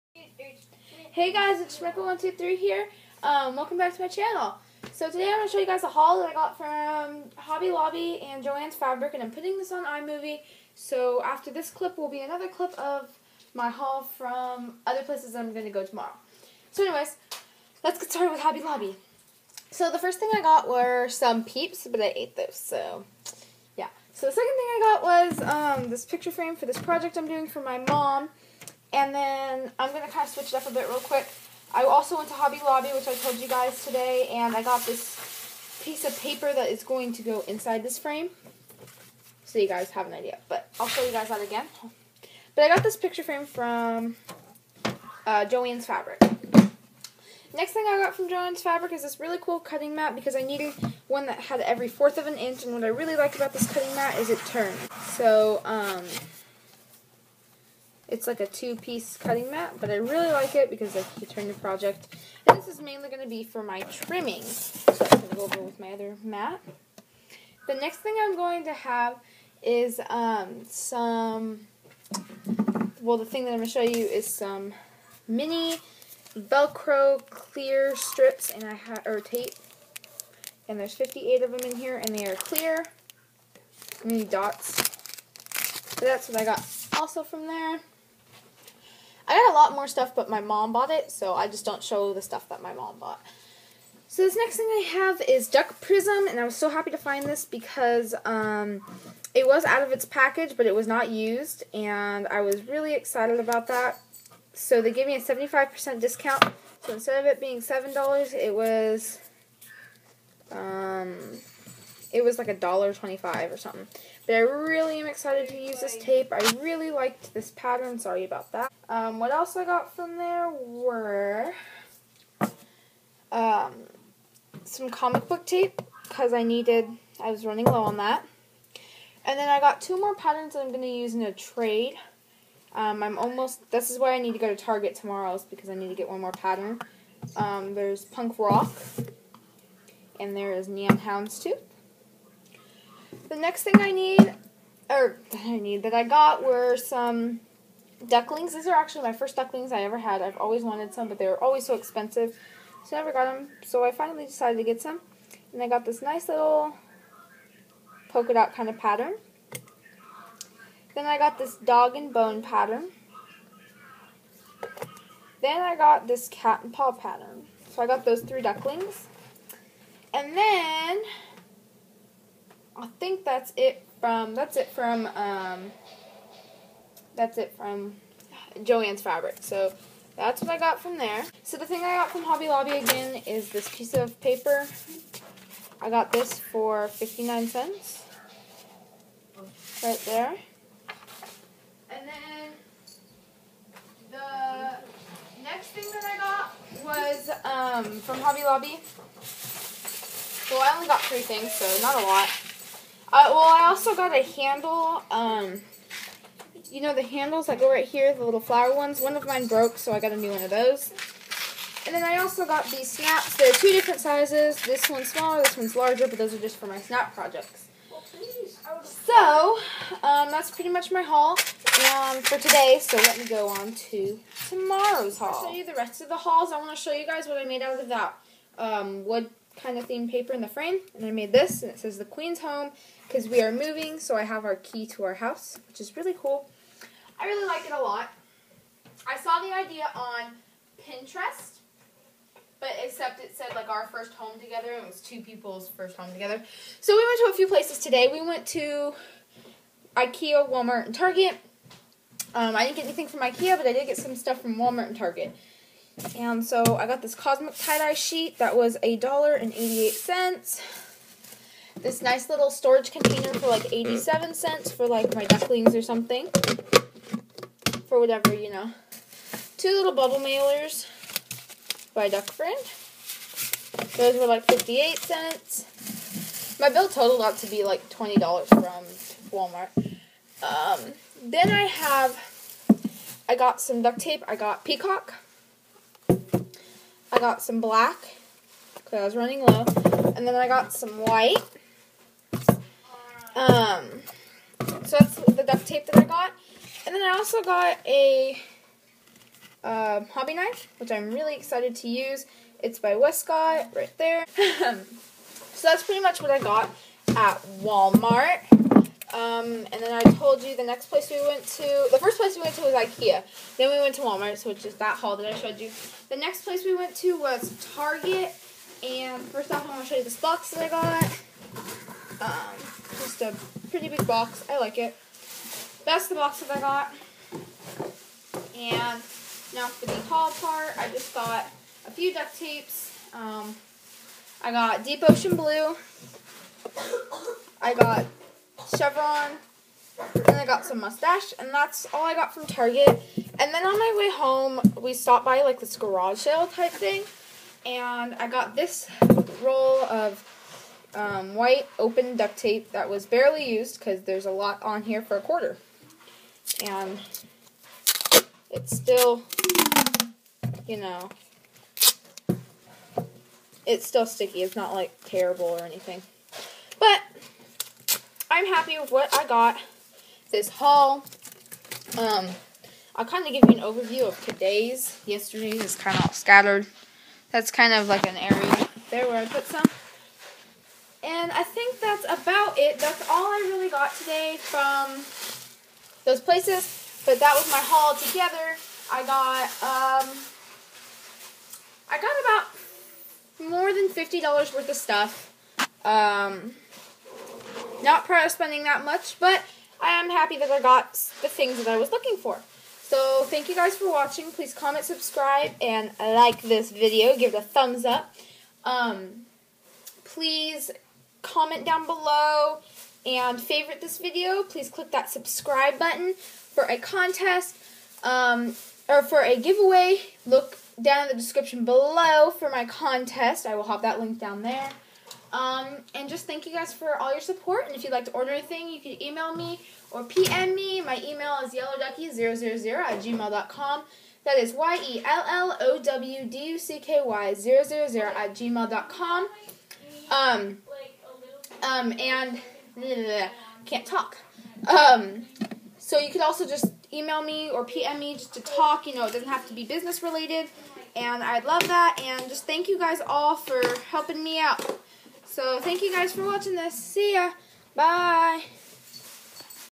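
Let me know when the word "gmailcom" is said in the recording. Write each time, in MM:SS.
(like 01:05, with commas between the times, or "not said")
07:13, 07:18.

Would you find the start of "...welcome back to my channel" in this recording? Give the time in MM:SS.
00:03.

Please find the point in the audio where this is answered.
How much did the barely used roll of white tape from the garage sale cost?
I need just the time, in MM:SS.
05:55.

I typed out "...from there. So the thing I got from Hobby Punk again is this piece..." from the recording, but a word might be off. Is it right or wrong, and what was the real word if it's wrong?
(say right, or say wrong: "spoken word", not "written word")
wrong: "Lobby", not "Punk".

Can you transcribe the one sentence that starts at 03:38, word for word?
So, um, that's pretty much my haul um, for today.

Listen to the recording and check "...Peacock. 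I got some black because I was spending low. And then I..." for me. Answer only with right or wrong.
wrong.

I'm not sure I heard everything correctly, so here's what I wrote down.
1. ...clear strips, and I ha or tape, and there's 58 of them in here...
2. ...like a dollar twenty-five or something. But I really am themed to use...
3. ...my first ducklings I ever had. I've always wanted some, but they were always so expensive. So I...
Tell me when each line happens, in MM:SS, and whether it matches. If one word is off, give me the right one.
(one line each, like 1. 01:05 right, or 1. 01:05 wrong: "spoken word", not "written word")
1. 01:17 right
2. 01:52 wrong: "excited", not "themed"
3. 02:29 right.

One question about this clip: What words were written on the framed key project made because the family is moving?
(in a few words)
the Queen's Home.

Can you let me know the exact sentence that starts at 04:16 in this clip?
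And so I got this Cosmic Tie-Dye sheet that was a dollar and 88 cents.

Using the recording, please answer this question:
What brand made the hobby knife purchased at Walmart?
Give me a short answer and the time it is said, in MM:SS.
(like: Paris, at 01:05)
Westcott, at 05:02.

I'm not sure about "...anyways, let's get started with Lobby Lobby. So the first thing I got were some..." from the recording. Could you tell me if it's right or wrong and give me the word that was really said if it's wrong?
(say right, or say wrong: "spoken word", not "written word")
wrong: "Hobby", not "Lobby".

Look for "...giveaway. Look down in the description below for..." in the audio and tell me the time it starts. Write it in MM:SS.
06:59.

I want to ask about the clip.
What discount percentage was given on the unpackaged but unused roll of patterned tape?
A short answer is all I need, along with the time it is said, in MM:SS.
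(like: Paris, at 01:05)
75%, at 01:45.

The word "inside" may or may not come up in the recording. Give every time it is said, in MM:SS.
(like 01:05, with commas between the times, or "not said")
00:37.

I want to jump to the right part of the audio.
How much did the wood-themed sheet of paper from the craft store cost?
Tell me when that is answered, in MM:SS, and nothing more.
03:06.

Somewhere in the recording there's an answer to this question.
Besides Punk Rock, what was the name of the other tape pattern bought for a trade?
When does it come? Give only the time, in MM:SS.
02:20.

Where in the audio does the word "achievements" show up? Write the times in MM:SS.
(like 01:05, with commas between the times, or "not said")
not said.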